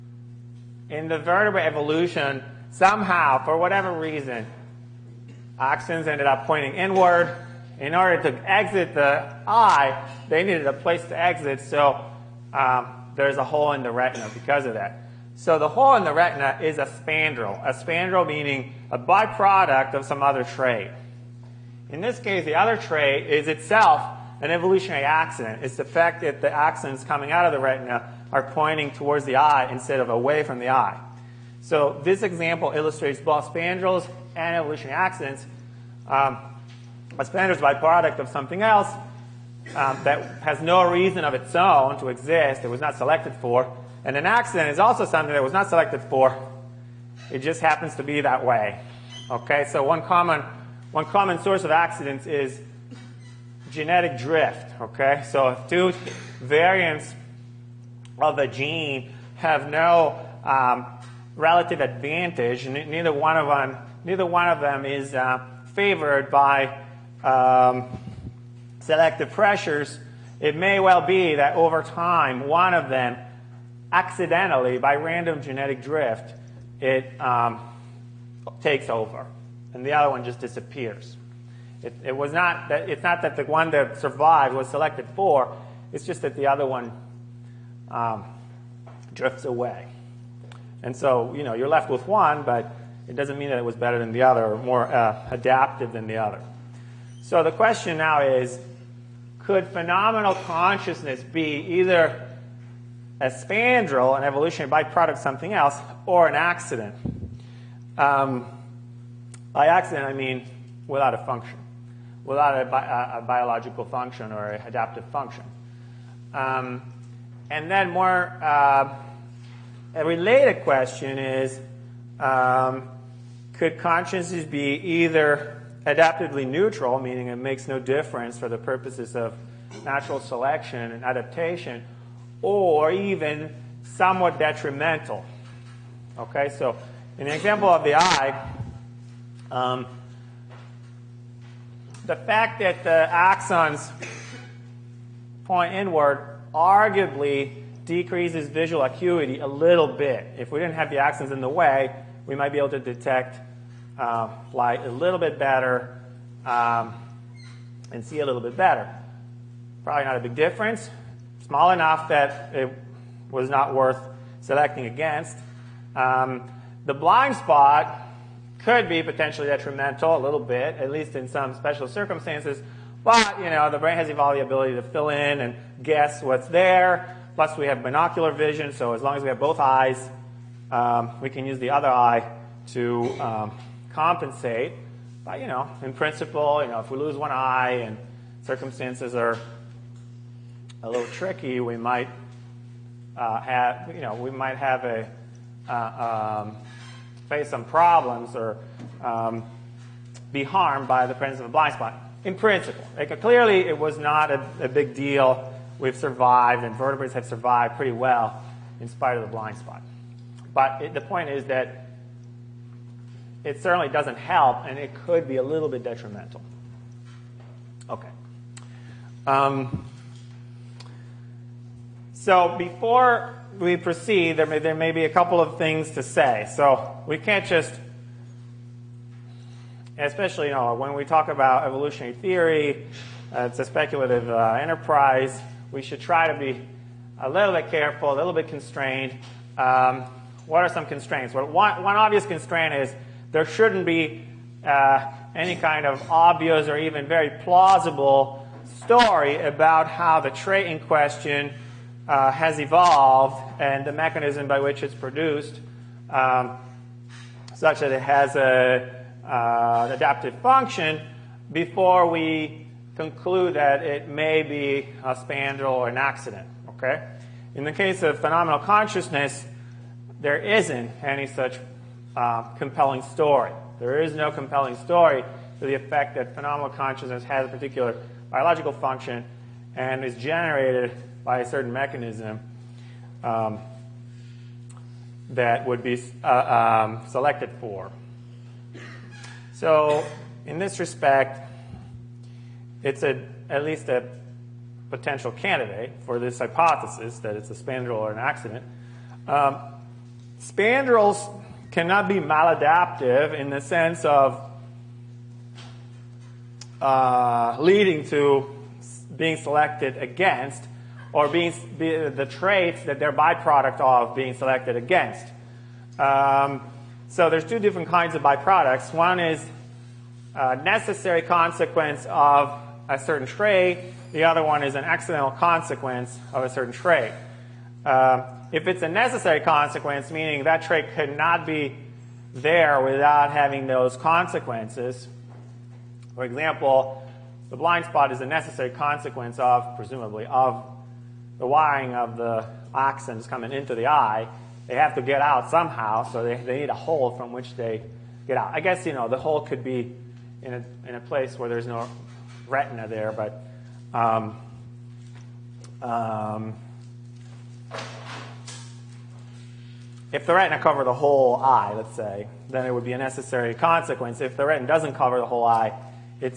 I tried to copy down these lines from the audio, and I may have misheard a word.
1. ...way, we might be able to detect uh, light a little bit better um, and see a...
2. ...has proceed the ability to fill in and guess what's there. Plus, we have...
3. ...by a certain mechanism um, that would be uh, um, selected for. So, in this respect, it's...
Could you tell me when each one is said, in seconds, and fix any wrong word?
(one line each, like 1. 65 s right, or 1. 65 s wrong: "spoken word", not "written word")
1. 151 s right
2. 173 s wrong: "evolved", not "proceed"
3. 281 s right.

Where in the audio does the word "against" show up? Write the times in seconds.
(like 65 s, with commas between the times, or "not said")
164 s, 309 s, 314 s.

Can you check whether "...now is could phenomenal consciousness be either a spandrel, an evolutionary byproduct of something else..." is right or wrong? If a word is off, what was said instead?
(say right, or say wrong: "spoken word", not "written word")
right.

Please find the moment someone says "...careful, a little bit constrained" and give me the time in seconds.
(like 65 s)
237 s.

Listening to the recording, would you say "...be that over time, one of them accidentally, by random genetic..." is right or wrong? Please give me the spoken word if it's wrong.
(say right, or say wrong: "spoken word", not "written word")
right.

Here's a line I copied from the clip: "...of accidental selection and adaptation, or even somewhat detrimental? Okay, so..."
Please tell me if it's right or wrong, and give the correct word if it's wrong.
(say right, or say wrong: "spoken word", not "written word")
wrong: "natural", not "accidental".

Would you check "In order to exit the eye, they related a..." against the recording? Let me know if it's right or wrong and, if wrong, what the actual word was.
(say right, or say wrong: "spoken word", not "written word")
wrong: "needed", not "related".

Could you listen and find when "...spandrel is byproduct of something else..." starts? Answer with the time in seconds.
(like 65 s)
37 s.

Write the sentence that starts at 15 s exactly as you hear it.
So the hole in the retina is a spandrel, a spandrel meaning a byproduct of some other trait.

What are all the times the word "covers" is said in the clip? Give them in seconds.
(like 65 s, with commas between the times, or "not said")
360 s, 364 s.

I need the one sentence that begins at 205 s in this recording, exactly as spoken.
We've survived, and vertebrates have survived pretty well in spite of the blind spot.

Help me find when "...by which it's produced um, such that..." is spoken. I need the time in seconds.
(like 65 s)
254 s.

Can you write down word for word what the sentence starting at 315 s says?
Um, so there's two different kinds of byproducts.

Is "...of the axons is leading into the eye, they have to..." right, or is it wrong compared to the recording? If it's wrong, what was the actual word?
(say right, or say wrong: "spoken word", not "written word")
wrong: "coming", not "leading".